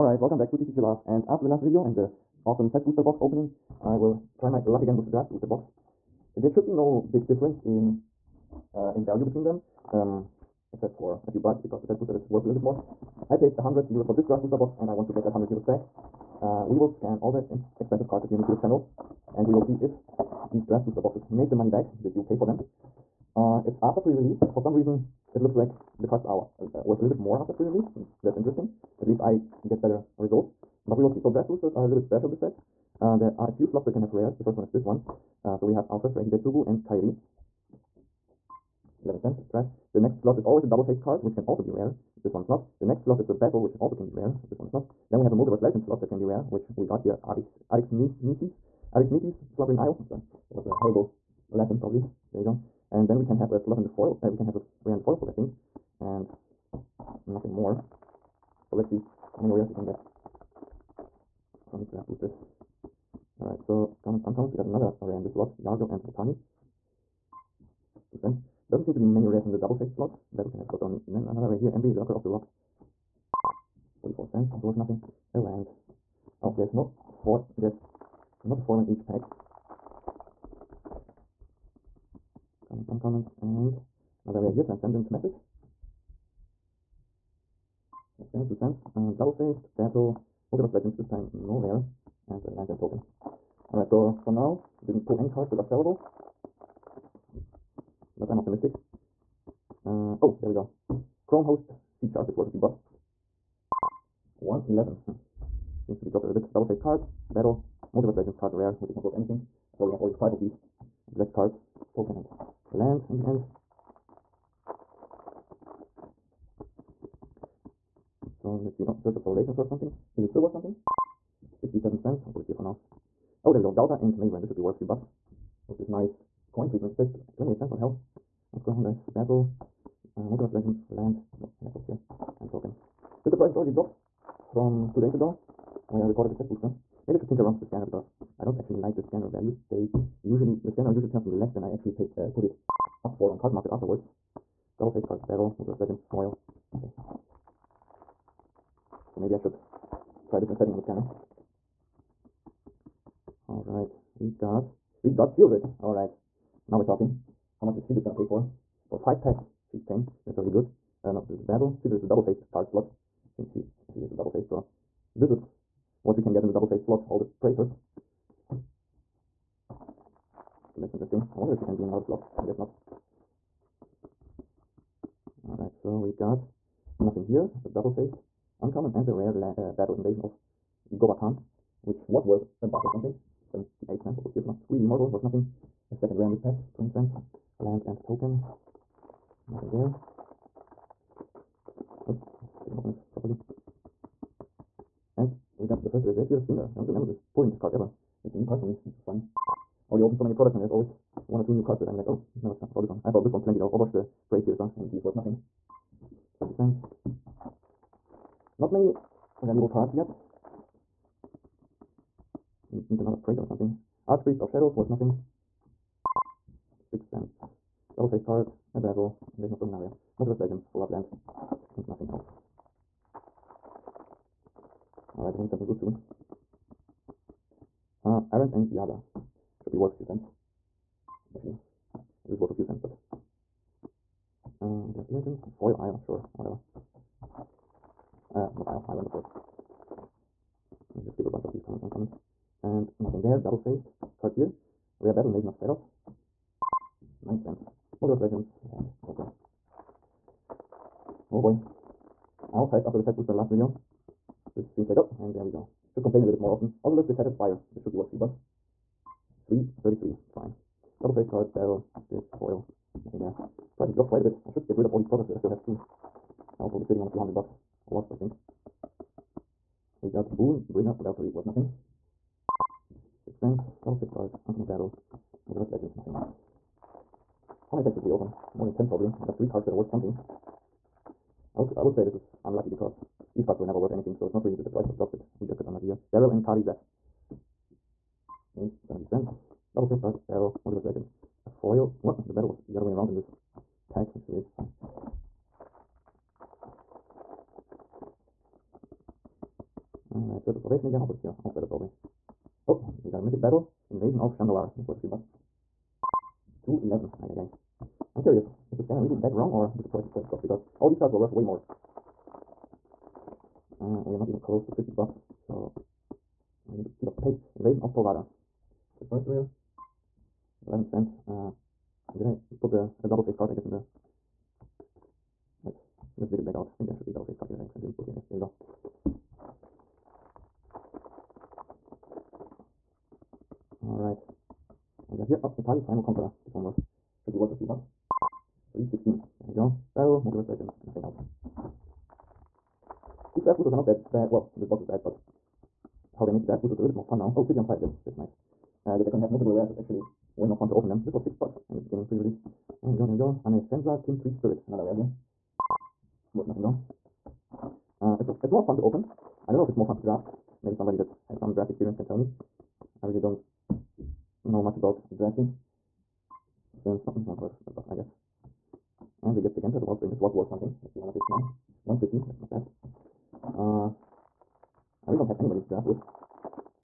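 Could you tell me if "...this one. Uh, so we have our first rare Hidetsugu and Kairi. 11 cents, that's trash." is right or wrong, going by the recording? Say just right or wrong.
right.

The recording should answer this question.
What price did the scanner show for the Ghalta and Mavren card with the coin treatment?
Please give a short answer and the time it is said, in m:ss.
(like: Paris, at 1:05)
28 cents, at 2:07.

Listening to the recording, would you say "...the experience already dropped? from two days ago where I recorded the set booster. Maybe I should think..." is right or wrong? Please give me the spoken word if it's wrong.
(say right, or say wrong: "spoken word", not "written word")
wrong: "price", not "experience".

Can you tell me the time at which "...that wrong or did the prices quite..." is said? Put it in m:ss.
5:09.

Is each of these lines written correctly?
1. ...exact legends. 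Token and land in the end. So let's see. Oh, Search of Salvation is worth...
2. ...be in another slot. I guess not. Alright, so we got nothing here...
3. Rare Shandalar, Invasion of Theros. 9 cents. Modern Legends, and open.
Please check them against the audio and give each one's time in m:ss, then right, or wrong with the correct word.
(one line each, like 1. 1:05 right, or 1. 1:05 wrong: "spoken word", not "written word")
1. 1:51 wrong: "cards", not "legends"
2. 2:51 right
3. 4:05 wrong: "Battle", not "Shandalar".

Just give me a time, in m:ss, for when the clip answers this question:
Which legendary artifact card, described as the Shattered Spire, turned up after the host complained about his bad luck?
4:16.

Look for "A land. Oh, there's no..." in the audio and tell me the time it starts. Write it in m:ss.
1:15.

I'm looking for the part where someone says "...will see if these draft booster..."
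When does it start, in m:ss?
0:19.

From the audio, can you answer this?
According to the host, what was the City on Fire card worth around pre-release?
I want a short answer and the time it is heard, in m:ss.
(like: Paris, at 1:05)
6 bucks, at 5:51.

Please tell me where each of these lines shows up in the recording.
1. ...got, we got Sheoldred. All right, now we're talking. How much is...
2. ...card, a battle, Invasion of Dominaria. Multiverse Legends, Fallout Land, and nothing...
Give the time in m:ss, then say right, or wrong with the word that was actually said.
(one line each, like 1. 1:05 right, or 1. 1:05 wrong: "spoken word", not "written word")
1. 2:34 right
2. 3:38 right.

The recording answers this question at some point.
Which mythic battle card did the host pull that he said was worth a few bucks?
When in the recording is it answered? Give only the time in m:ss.
5:03.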